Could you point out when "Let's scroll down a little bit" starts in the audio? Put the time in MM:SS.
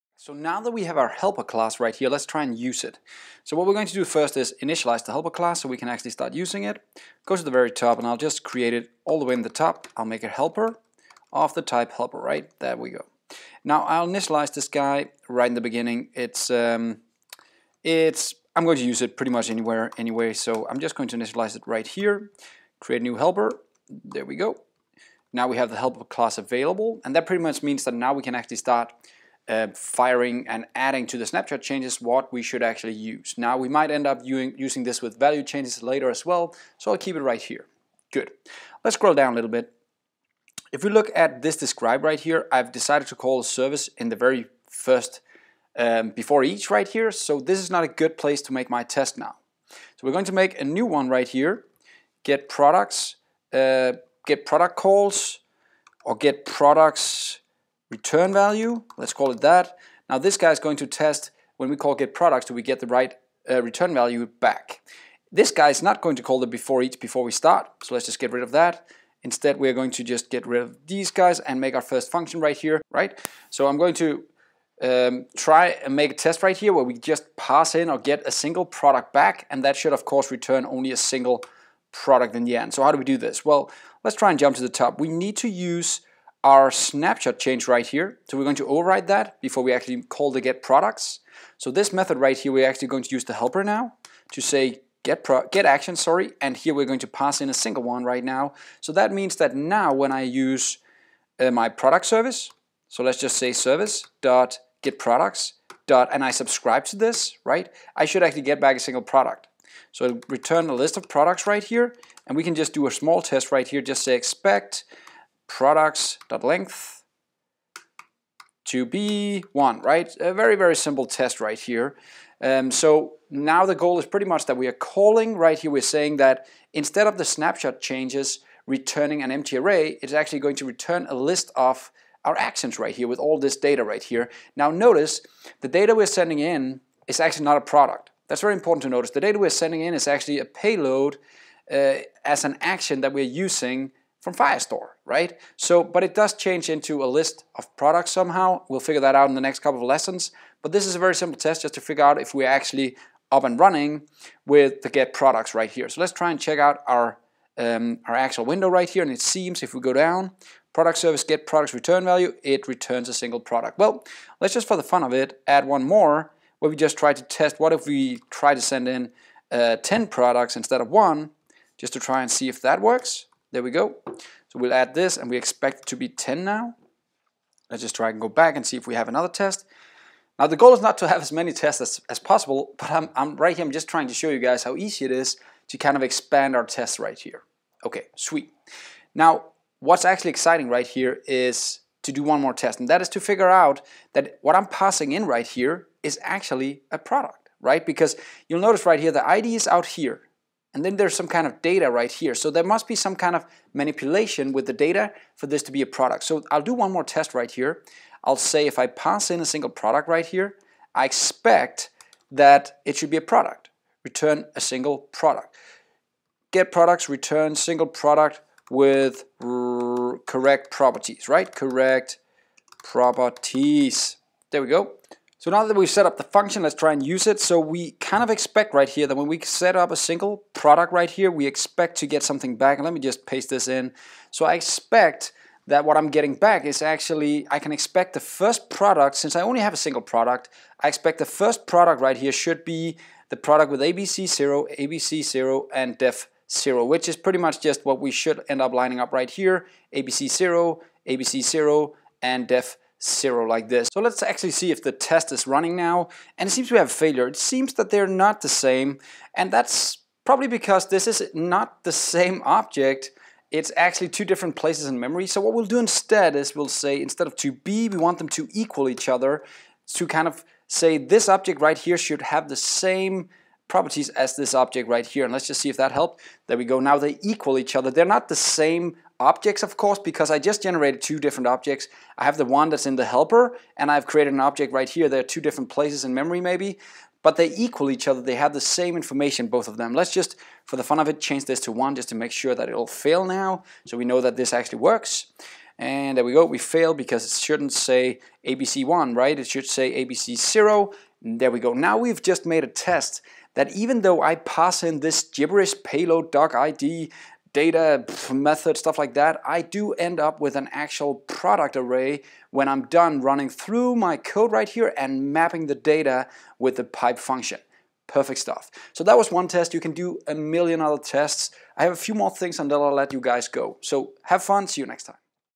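00:38.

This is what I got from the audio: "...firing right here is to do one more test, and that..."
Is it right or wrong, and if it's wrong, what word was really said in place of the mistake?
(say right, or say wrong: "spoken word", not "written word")
wrong: "exciting", not "firing".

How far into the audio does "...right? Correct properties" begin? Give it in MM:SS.
03:41.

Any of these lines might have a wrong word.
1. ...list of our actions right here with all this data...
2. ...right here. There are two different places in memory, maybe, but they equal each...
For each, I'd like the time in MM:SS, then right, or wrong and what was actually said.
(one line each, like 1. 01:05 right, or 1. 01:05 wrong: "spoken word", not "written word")
1. 02:11 right
2. 04:44 right.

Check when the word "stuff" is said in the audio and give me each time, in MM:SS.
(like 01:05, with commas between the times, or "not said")
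05:08, 05:18.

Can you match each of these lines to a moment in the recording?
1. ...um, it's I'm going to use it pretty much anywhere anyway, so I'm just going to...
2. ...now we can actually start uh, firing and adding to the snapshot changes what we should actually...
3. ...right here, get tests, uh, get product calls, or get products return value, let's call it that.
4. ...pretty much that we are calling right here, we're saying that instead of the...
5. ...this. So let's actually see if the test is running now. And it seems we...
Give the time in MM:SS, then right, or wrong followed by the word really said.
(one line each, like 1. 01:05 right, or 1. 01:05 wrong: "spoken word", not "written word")
1. 00:16 right
2. 00:27 right
3. 00:51 wrong: "products", not "tests"
4. 02:04 right
5. 04:13 right.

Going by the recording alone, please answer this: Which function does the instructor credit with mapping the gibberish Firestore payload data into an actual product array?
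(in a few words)
pipe.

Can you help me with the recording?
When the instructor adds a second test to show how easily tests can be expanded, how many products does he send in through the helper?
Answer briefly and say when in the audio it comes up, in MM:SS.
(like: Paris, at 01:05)
10, at 02:49.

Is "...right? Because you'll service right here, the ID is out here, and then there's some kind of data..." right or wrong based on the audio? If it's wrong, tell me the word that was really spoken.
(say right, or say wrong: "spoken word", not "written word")
wrong: "notice", not "service".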